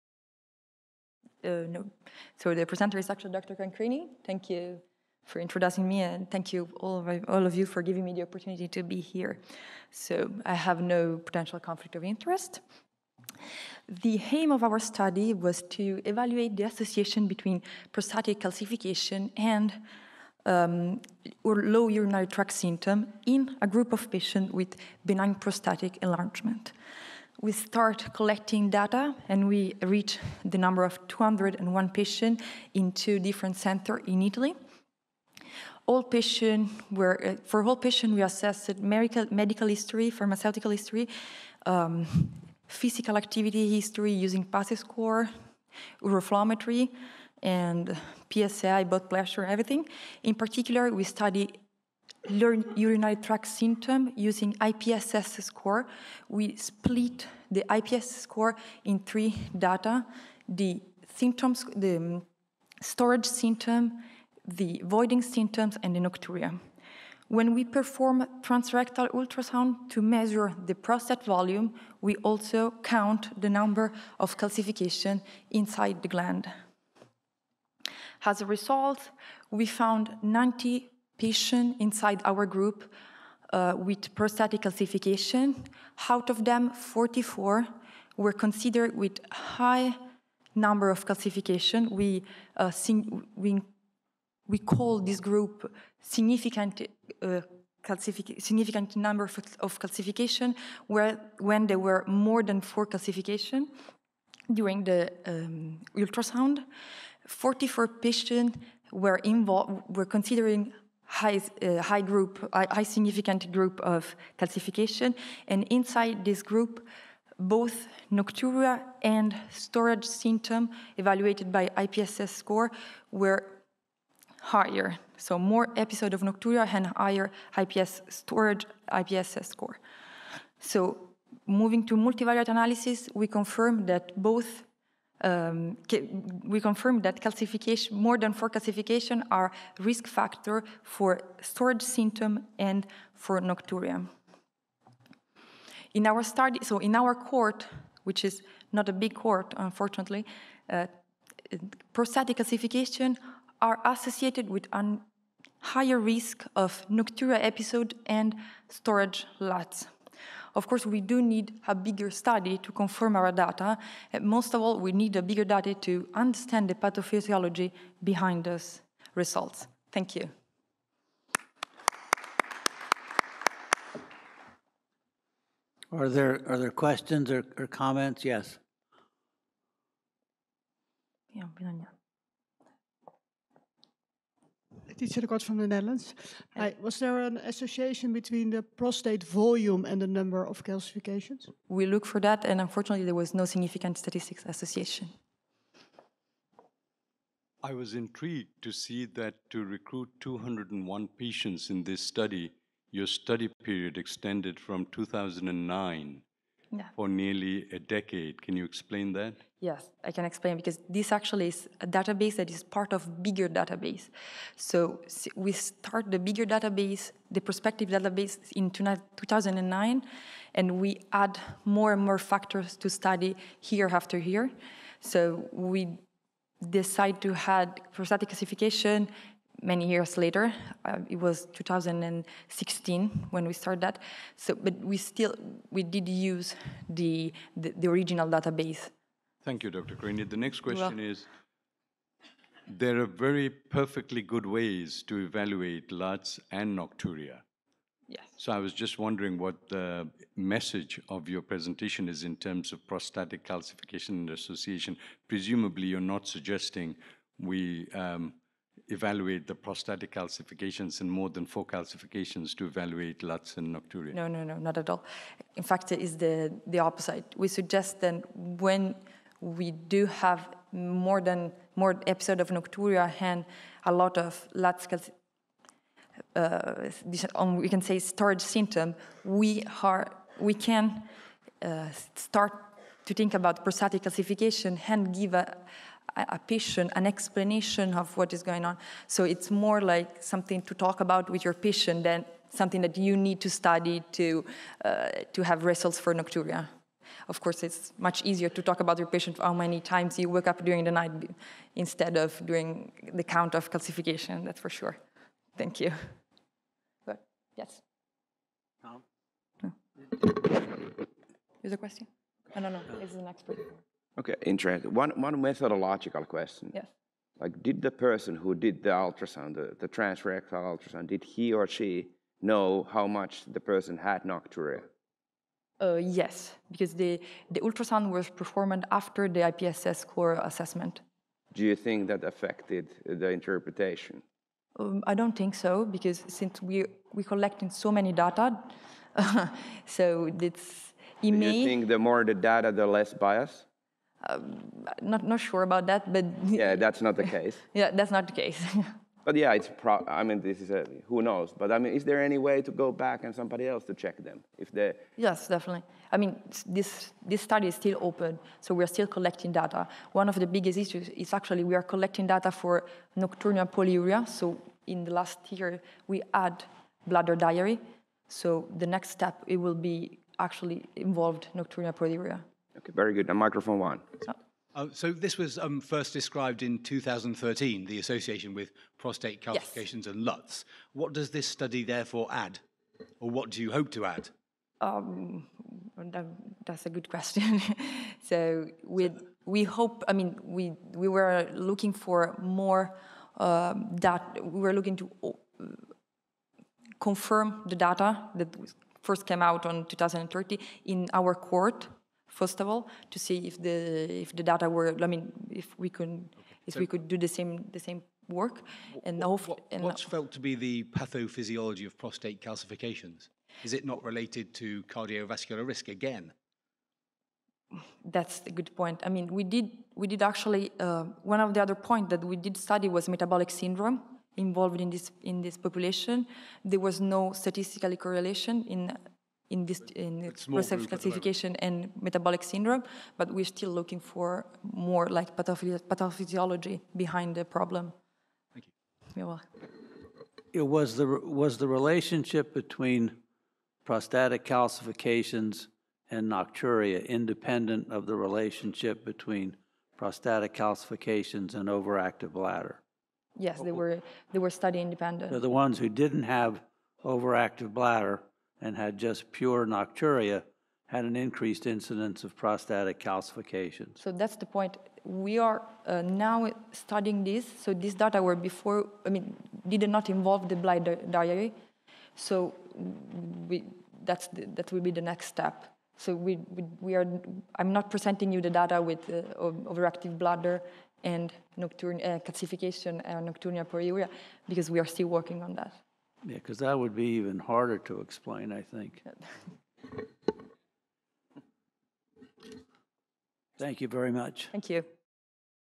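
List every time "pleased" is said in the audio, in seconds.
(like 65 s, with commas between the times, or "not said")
not said.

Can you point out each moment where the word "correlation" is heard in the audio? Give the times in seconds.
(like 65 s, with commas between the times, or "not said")
428 s.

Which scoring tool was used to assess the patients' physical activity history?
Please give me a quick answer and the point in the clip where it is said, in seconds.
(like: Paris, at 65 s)
PASI score, at 44 s.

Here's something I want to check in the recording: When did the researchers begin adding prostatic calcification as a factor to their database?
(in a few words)
2016.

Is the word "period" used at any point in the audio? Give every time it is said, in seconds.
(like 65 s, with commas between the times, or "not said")
203 s.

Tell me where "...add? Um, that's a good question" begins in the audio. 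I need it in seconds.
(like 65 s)
384 s.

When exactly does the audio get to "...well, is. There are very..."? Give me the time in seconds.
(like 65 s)
240 s.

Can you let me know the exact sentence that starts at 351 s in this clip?
But I mean, is there any way to go back and somebody else to check them if they?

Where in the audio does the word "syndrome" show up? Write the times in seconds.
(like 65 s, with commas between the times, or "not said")
423 s, 432 s.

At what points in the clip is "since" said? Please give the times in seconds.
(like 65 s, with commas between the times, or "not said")
336 s.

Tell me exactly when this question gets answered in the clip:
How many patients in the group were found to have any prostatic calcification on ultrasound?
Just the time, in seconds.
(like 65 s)
80 s.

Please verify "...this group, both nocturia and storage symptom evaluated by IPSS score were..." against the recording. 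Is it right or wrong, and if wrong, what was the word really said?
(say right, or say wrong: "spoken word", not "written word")
right.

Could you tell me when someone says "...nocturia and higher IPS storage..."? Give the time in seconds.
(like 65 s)
126 s.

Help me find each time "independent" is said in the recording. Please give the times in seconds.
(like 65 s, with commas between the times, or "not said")
447 s, 454 s.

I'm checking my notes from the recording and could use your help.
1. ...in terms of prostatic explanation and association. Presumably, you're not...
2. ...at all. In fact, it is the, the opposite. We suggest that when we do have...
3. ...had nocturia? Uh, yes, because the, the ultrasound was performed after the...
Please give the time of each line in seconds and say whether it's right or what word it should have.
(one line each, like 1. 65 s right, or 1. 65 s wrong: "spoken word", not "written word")
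1. 252 s wrong: "calcification", not "explanation"
2. 264 s right
3. 323 s right.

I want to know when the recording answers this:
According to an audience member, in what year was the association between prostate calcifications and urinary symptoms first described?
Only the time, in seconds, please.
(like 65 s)
376 s.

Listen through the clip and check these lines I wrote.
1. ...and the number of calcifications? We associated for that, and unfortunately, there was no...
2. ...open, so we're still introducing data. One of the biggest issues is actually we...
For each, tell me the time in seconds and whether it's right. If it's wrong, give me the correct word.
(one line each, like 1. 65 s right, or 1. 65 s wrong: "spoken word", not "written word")
1. 189 s wrong: "looked", not "associated"
2. 358 s wrong: "collecting", not "introducing".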